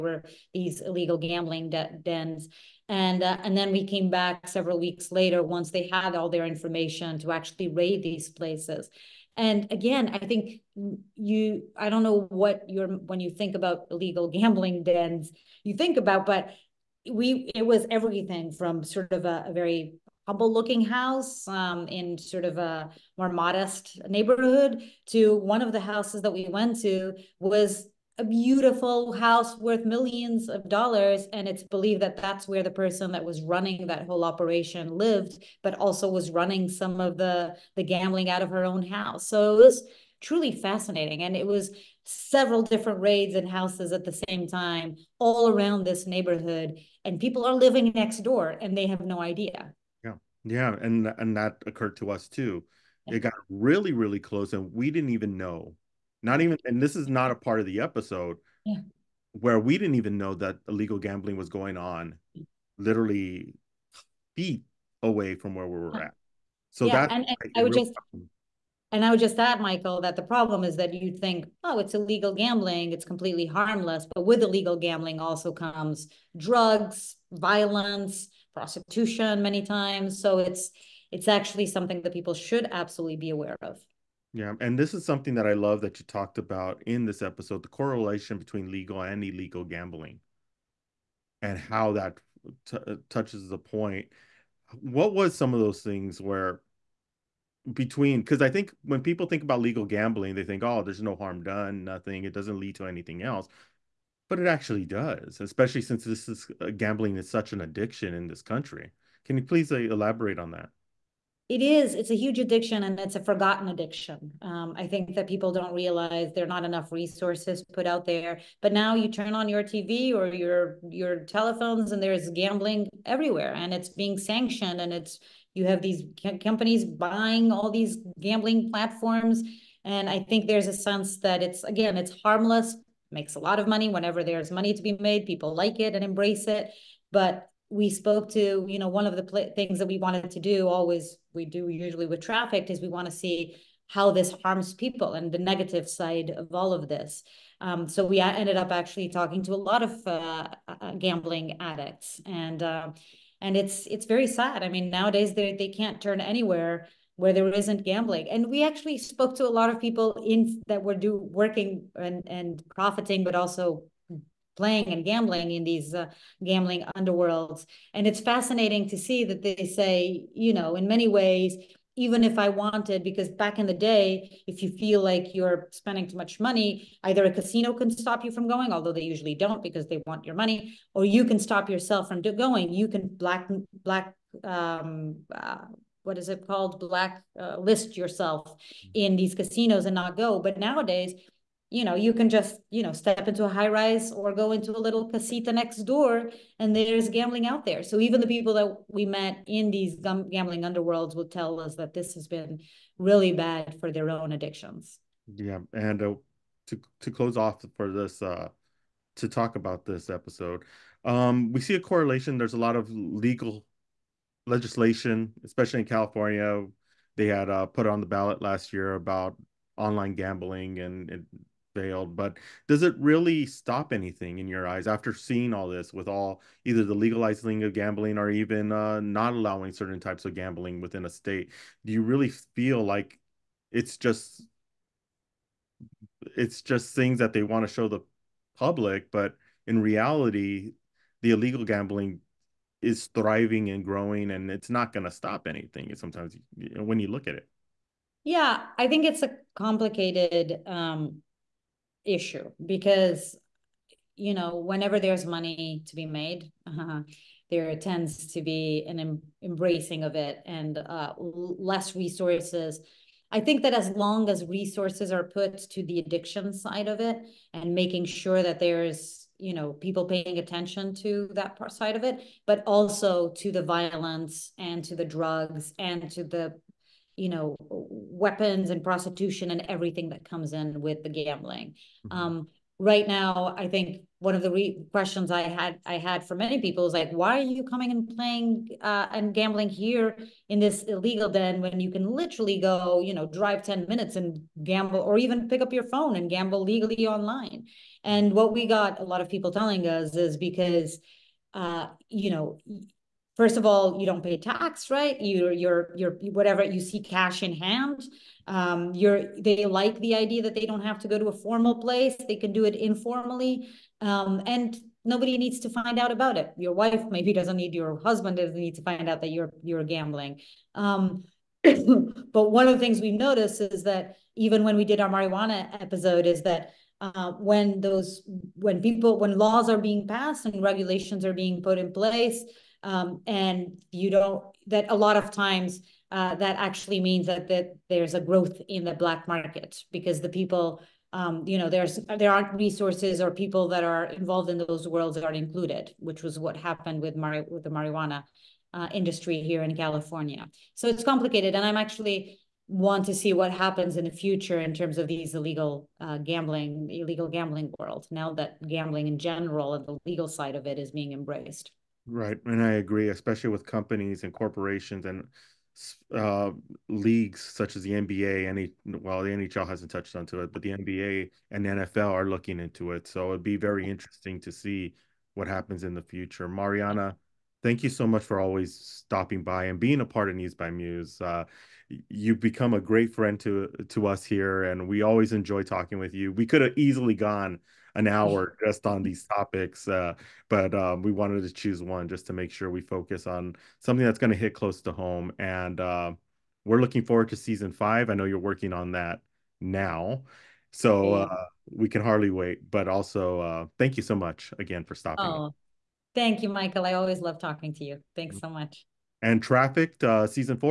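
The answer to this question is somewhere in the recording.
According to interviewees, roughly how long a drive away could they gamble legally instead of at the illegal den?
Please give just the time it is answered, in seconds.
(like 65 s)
293 s.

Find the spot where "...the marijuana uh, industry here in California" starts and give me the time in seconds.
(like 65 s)
347 s.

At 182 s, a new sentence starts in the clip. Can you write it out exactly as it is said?
You can black black um, uh, what is it called black uh, list yourself mm-hmm.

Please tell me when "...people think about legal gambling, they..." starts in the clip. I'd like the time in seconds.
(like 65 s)
99 s.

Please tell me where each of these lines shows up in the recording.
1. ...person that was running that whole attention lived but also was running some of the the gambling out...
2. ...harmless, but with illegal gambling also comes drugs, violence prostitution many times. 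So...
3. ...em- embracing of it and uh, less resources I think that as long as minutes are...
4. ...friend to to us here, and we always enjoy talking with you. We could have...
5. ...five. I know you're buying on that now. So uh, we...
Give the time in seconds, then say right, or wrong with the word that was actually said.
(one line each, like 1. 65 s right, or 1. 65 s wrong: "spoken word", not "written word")
1. 32 s wrong: "operation", not "attention"
2. 73 s right
3. 258 s wrong: "resources", not "minutes"
4. 383 s right
5. 397 s wrong: "working", not "buying".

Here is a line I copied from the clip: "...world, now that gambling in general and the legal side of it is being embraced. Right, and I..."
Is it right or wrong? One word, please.
right.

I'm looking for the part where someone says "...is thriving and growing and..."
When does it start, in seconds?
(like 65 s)
242 s.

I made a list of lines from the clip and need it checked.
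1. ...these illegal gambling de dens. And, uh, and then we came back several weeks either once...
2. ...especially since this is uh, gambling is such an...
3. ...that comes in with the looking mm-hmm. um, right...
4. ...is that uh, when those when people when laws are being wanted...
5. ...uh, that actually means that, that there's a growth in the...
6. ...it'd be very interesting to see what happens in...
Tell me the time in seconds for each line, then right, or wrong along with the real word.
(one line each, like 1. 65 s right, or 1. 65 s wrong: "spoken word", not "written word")
1. 0 s wrong: "later", not "either"
2. 105 s right
3. 280 s wrong: "gambling", not "looking"
4. 326 s wrong: "passed", not "wanted"
5. 336 s right
6. 373 s right.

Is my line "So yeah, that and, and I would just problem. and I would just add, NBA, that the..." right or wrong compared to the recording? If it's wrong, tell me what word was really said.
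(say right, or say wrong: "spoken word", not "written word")
wrong: "Michael", not "NBA".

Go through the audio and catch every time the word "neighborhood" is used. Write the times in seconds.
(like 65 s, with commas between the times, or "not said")
24 s, 46 s.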